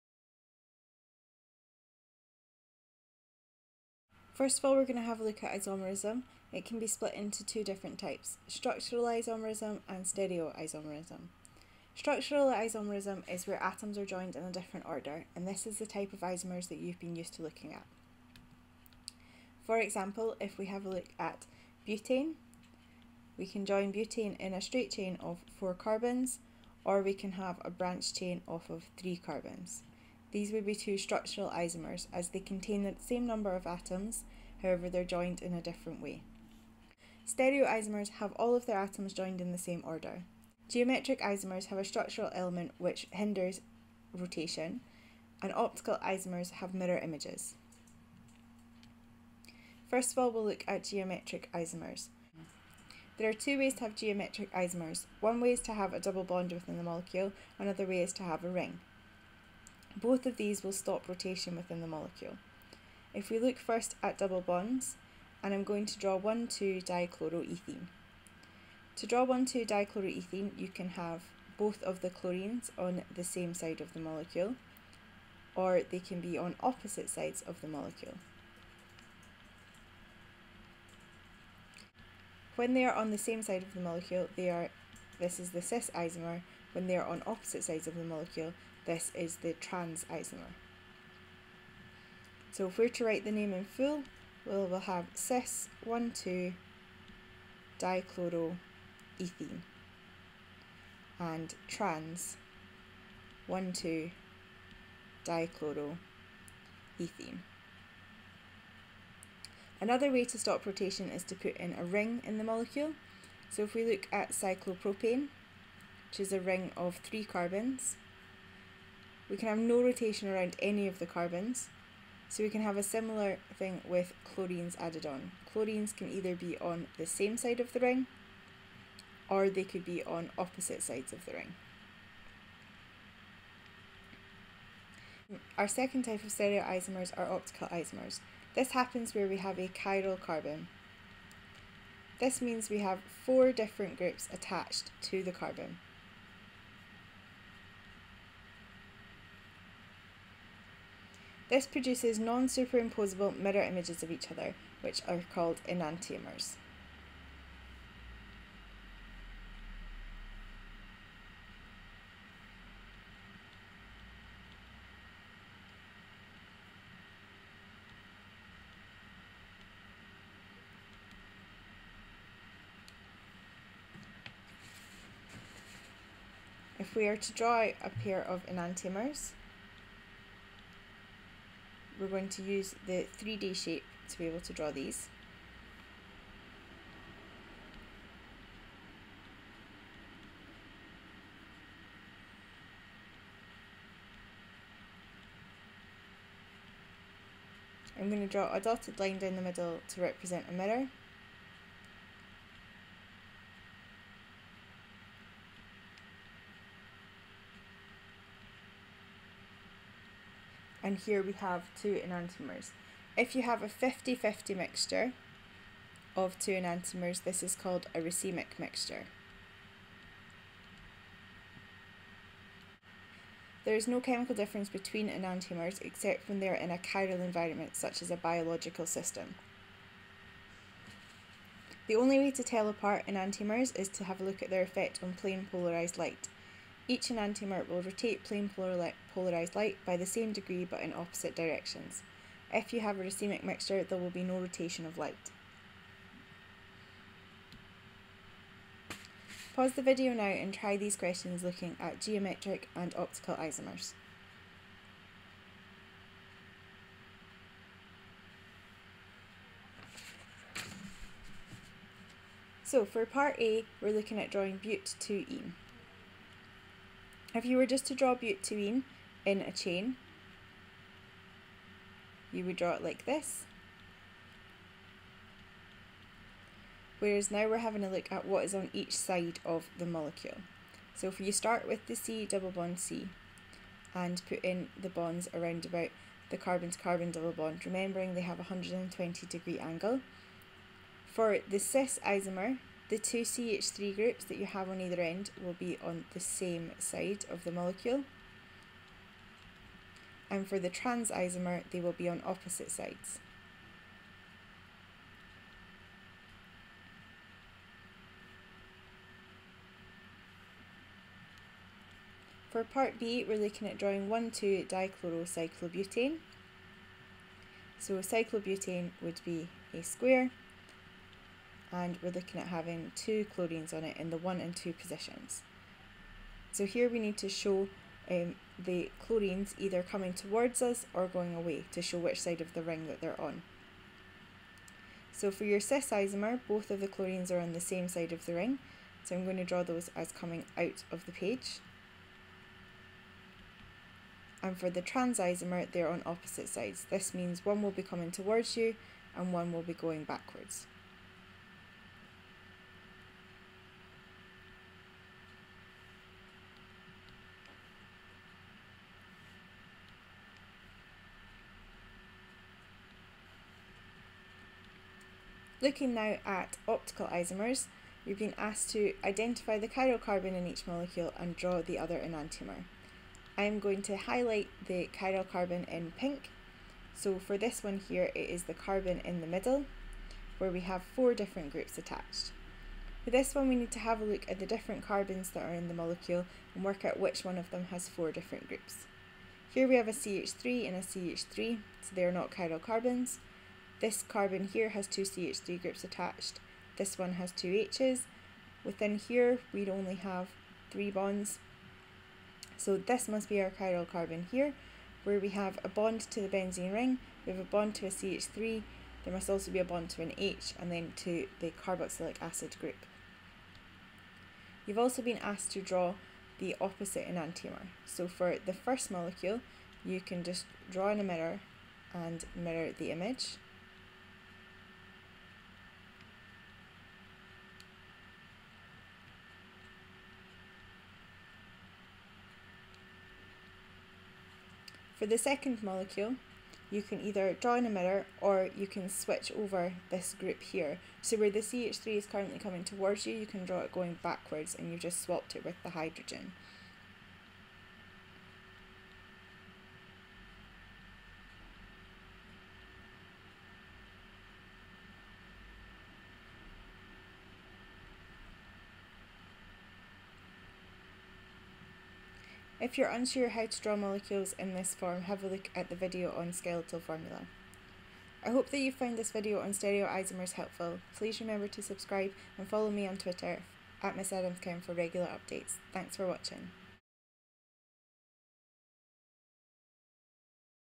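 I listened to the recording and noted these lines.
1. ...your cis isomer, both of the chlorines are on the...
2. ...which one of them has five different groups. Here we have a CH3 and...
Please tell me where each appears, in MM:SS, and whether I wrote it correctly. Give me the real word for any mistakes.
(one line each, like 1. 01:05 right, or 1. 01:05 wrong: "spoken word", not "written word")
1. 05:35 right
2. 06:26 wrong: "four", not "five".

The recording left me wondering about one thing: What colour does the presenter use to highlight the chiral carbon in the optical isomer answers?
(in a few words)
pink.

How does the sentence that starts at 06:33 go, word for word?
This carbon here has two CH3 groups attached.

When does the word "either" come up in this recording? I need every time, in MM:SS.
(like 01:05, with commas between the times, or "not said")
02:06, 04:54, 05:29, 07:17.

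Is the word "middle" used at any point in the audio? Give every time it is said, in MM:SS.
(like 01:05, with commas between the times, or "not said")
03:19, 06:19.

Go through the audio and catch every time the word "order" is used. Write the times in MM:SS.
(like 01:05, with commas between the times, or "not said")
00:14, 00:39.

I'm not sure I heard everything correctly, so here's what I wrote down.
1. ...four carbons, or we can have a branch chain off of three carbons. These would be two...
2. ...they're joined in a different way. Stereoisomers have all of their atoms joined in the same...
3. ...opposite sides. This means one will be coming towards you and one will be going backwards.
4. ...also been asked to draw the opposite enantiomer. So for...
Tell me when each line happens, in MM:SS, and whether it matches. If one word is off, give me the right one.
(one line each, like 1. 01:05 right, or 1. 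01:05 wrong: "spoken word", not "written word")
1. 00:25 right
2. 00:34 right
3. 05:46 right
4. 06:54 right.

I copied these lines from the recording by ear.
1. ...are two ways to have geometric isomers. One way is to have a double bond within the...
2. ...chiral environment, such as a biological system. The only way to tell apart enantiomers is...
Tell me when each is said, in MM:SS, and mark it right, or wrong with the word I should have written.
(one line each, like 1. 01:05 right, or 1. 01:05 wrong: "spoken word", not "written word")
1. 00:53 right
2. 03:46 right.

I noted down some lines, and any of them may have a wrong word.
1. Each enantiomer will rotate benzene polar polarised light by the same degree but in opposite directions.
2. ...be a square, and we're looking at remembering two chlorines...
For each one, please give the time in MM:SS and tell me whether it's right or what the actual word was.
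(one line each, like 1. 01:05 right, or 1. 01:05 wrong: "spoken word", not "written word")
1. 03:56 wrong: "plane", not "benzene"
2. 05:19 wrong: "having", not "remembering".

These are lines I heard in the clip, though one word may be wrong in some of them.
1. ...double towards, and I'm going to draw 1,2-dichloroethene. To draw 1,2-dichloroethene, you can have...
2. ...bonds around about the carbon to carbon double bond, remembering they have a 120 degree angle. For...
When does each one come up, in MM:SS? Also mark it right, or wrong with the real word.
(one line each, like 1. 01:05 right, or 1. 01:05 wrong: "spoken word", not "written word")
1. 01:04 wrong: "bonds", not "towards"
2. 04:44 right.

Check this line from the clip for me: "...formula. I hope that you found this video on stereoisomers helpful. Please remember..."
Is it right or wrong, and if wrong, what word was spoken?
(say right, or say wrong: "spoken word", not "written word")
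right.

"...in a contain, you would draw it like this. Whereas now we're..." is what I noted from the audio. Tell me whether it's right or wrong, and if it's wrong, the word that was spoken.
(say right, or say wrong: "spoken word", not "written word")
wrong: "chain", not "contain".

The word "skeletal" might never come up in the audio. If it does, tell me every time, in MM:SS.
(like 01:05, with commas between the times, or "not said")
07:46.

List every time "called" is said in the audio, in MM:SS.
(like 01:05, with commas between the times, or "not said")
02:35, 03:37.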